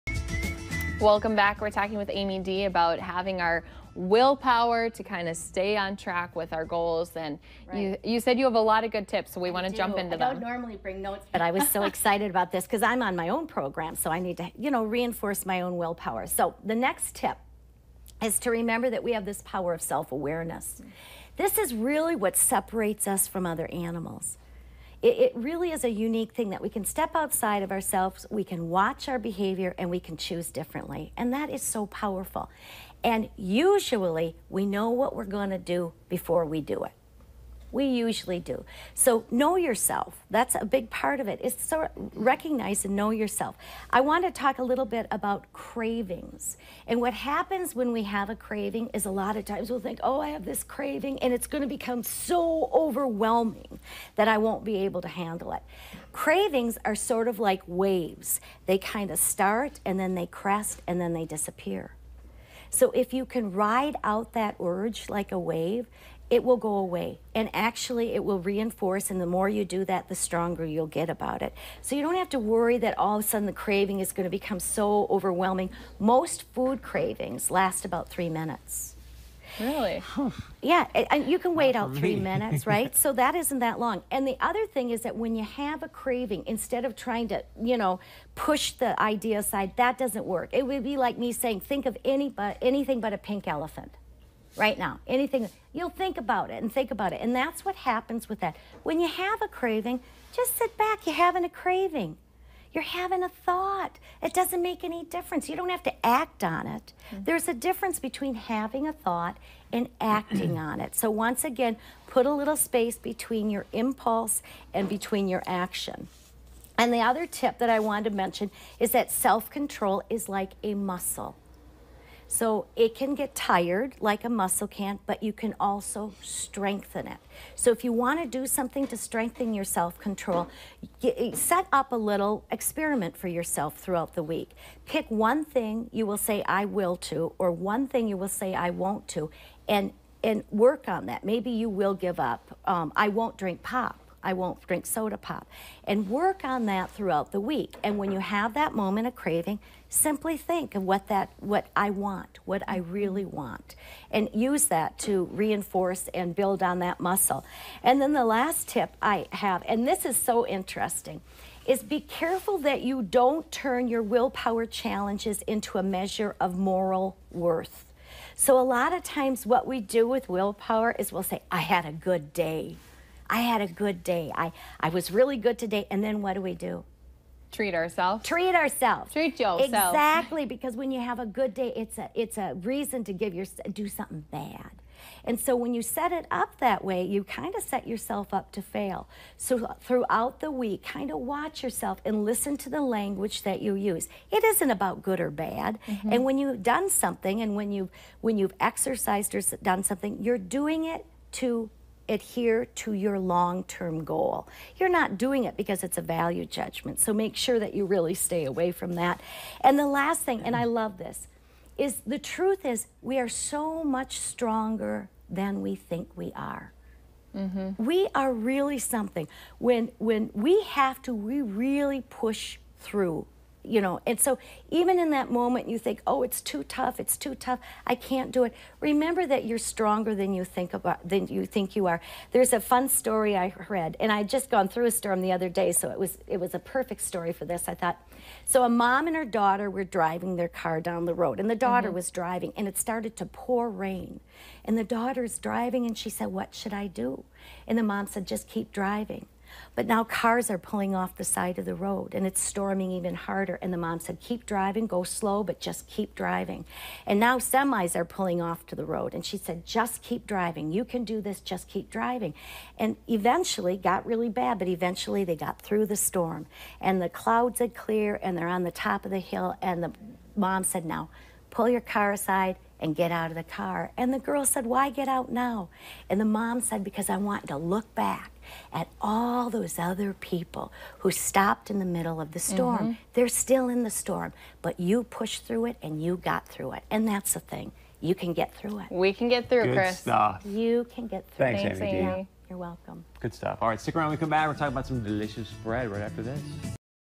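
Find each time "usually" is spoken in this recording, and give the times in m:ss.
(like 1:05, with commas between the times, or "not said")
0:33, 0:37.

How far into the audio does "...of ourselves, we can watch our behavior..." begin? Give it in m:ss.
0:27.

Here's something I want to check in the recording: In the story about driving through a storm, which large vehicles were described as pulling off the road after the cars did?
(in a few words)
semis.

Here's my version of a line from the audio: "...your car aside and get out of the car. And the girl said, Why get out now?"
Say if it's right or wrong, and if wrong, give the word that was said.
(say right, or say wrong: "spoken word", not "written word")
right.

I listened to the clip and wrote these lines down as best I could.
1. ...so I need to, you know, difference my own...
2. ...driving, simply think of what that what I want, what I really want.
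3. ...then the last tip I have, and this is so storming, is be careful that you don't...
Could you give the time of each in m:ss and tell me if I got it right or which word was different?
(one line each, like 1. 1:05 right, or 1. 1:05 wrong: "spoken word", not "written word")
1. 0:13 wrong: "reinforce", not "difference"
2. 2:29 wrong: "craving", not "driving"
3. 2:38 wrong: "interesting", not "storming".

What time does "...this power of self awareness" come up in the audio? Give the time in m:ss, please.
0:19.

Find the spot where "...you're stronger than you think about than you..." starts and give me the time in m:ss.
3:49.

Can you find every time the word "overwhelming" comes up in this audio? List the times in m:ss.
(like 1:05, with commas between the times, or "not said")
0:52, 1:15.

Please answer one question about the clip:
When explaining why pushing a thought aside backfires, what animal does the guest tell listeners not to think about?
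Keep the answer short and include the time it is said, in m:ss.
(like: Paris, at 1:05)
pink elephant, at 1:33.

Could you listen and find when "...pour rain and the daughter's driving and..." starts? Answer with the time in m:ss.
4:03.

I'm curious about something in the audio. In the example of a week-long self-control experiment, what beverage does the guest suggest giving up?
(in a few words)
soda pop.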